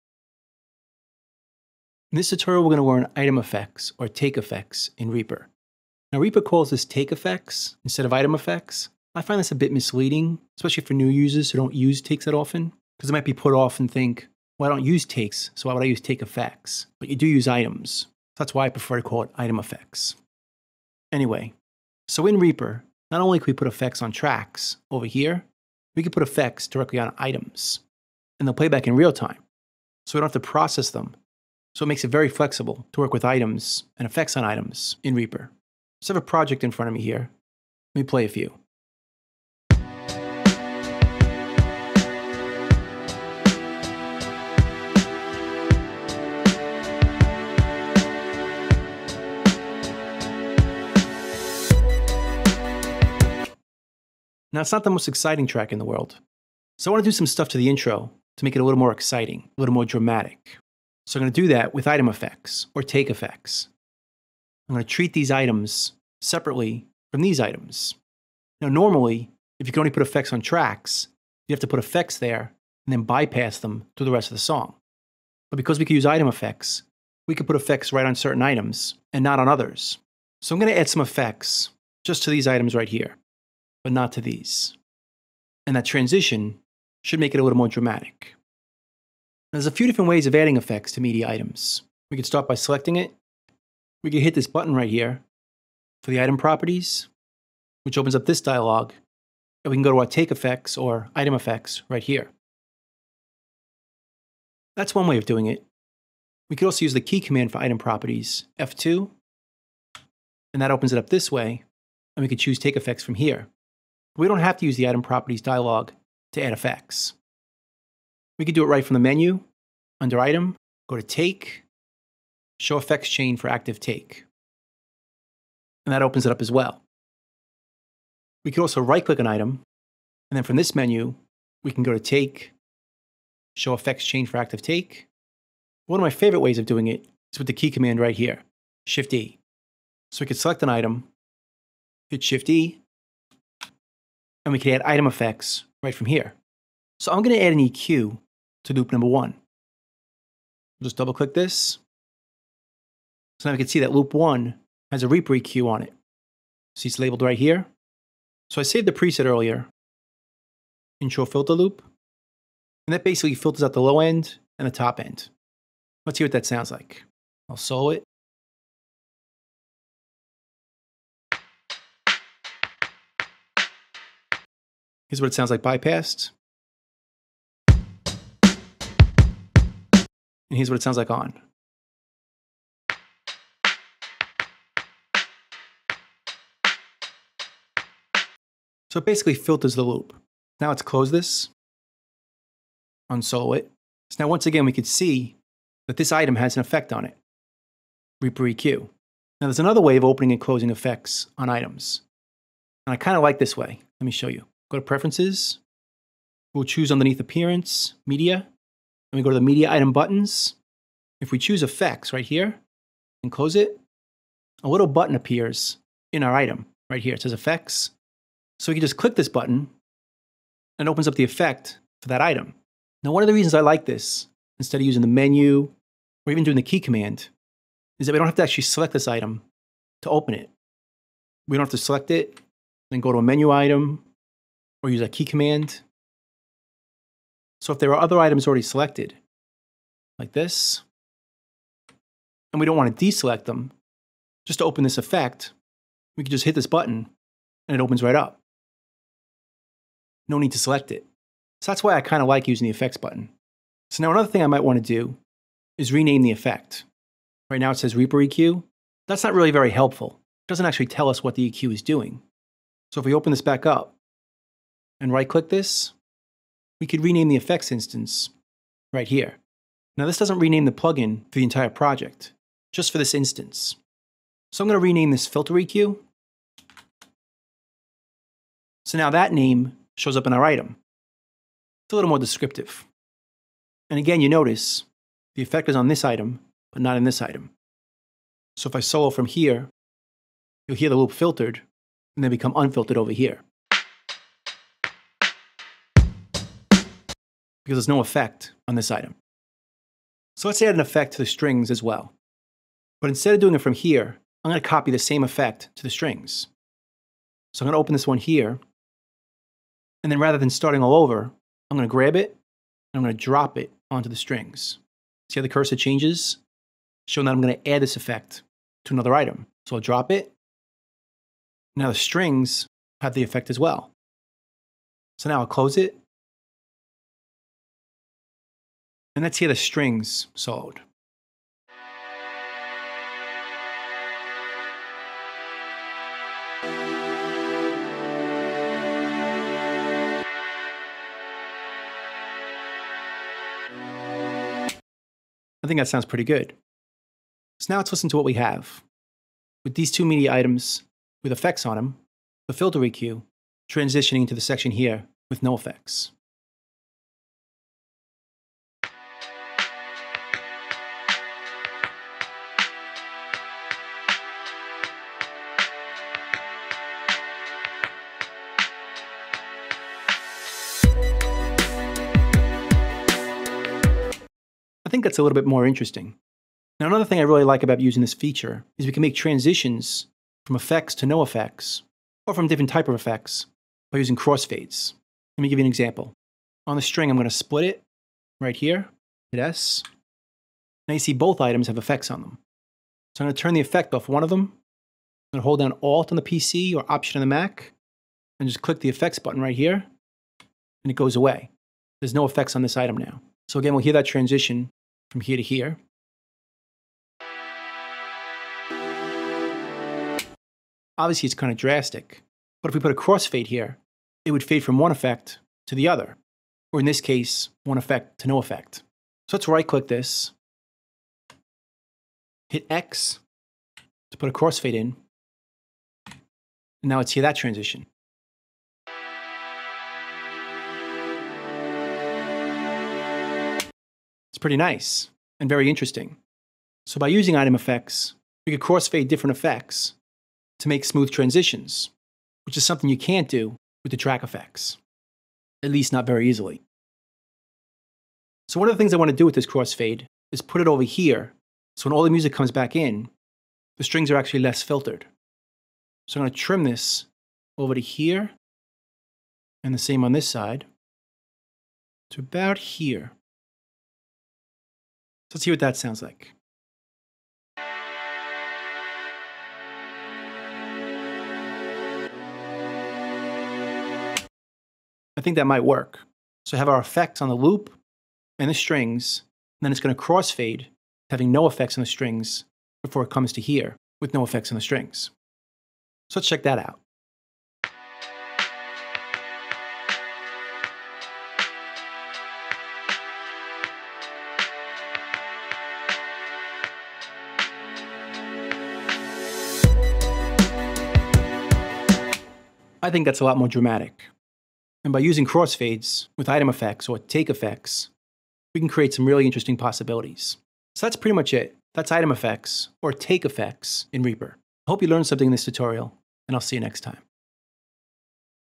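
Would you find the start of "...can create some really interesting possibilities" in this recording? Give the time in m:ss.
8:28.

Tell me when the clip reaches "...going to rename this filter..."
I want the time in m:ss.
4:34.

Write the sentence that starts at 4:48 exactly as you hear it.
So if I solo from here, you'll hear the loop filtered and then become unfiltered over here.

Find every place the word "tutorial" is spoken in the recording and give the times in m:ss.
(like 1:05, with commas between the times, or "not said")
0:02, 8:35.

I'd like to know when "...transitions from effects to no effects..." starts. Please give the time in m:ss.
6:19.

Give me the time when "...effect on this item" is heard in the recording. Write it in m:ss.
4:57.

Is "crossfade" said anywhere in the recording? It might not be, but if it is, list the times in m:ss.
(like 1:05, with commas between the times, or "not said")
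6:24, 6:52, 7:04, 7:18, 7:29, 8:00, 8:25.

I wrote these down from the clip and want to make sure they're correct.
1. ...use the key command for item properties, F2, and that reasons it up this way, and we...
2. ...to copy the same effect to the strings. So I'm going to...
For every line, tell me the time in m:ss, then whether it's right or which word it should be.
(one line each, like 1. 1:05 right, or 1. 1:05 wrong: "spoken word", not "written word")
1. 1:46 wrong: "opens", not "reasons"
2. 5:04 right.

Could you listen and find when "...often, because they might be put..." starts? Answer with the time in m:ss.
0:12.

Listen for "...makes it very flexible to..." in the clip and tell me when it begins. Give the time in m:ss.
0:31.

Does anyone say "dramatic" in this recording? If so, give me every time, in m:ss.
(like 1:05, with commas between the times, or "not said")
0:59, 1:27, 8:23.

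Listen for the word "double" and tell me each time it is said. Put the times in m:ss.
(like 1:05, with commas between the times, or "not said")
2:30.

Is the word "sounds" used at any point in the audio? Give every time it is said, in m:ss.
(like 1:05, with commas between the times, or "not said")
2:46, 2:55, 3:00, 5:45, 7:45.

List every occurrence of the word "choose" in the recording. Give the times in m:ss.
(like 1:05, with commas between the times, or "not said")
1:52, 3:26, 3:31.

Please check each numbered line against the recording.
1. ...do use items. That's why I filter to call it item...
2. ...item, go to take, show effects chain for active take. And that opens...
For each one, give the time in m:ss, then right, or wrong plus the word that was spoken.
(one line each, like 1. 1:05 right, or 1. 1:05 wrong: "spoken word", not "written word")
1. 0:17 wrong: "prefer", not "filter"
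2. 2:00 right.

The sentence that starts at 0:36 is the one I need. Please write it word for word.
So I have a project in front of me here.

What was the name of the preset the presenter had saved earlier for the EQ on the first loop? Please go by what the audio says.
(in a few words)
Intro filter loop.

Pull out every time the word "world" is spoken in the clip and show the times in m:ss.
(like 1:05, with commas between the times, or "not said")
0:55.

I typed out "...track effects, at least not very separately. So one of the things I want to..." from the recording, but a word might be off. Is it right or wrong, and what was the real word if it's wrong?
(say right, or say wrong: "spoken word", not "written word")
wrong: "easily", not "separately".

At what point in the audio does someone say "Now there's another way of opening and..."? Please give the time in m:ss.
3:19.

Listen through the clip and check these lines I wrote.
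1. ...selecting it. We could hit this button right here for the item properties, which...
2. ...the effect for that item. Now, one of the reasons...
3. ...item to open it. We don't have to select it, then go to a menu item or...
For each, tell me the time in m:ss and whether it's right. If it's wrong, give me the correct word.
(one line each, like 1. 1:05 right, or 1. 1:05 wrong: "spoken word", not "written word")
1. 1:32 right
2. 3:41 right
3. 3:49 right.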